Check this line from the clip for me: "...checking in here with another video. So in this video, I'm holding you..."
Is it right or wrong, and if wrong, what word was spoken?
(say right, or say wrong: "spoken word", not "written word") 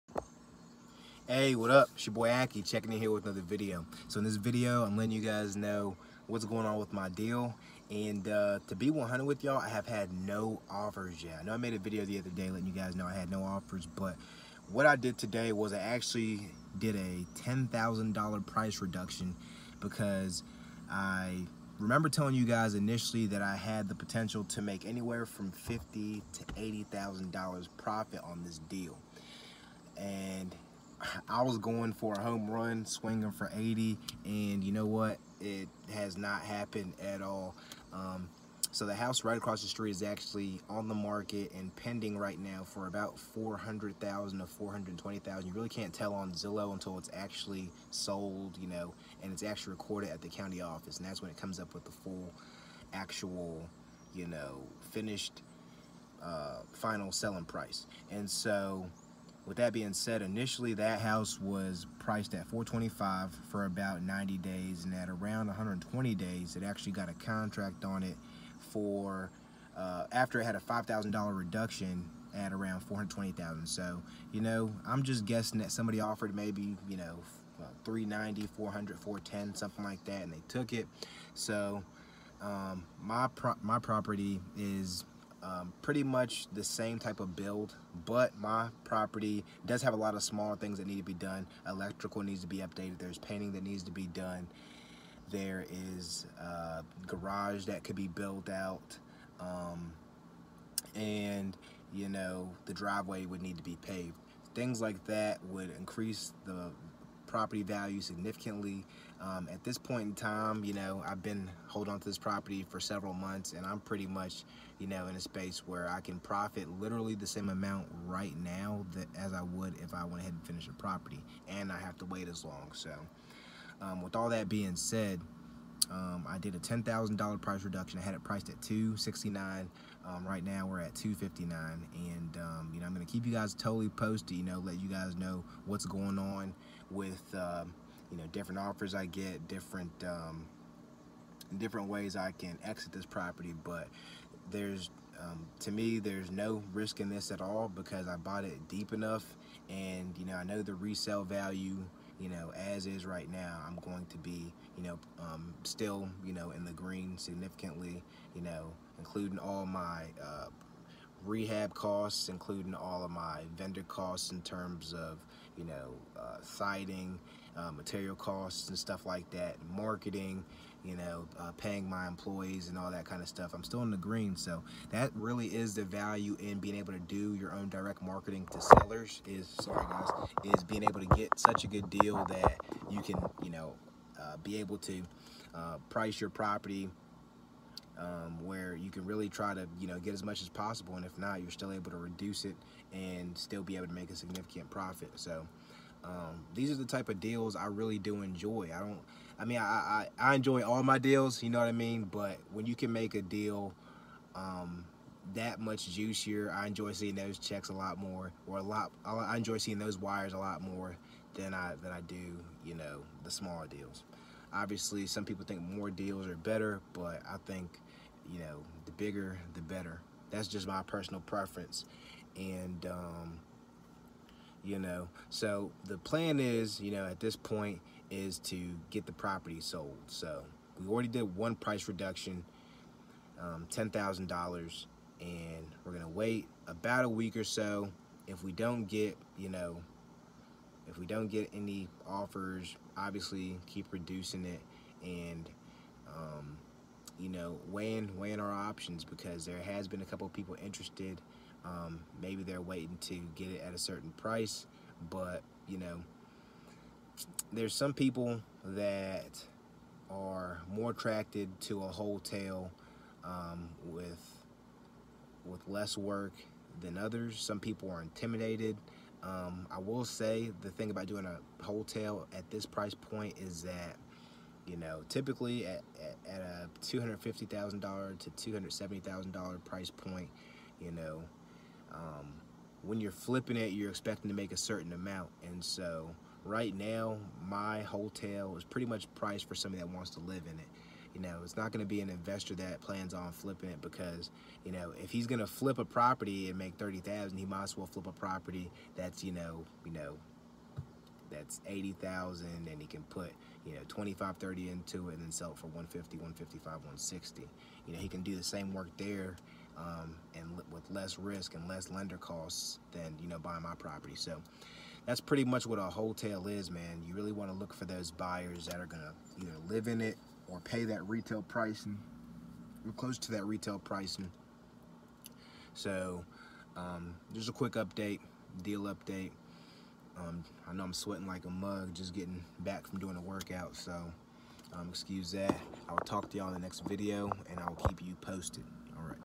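wrong: "letting", not "holding".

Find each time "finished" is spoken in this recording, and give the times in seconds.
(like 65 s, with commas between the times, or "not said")
54 s, 120 s.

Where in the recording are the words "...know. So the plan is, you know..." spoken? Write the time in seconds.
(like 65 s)
224 s.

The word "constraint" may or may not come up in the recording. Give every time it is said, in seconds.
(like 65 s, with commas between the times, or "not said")
not said.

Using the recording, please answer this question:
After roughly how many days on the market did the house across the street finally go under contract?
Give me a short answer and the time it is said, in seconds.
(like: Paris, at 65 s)
120 days, at 65 s.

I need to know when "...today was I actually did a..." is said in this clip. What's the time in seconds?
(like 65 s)
15 s.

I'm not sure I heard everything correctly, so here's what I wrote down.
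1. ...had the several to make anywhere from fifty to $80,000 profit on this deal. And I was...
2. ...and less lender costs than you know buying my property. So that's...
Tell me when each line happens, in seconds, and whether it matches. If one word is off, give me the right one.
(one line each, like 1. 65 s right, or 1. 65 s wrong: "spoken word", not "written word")
1. 23 s wrong: "potential", not "several"
2. 311 s right.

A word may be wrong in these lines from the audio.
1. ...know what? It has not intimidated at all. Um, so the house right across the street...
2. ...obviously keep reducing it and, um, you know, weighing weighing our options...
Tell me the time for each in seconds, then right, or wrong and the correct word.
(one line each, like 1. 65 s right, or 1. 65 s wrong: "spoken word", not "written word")
1. 34 s wrong: "happened", not "intimidated"
2. 242 s right.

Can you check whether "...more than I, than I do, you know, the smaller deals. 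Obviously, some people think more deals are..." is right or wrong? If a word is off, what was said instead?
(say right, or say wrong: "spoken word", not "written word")
right.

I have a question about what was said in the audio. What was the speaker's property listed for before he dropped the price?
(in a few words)
269.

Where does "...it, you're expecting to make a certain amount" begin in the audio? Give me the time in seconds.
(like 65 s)
283 s.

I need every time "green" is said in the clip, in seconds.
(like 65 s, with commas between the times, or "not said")
156 s, 173 s.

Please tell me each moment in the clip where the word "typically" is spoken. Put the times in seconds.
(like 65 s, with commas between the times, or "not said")
275 s.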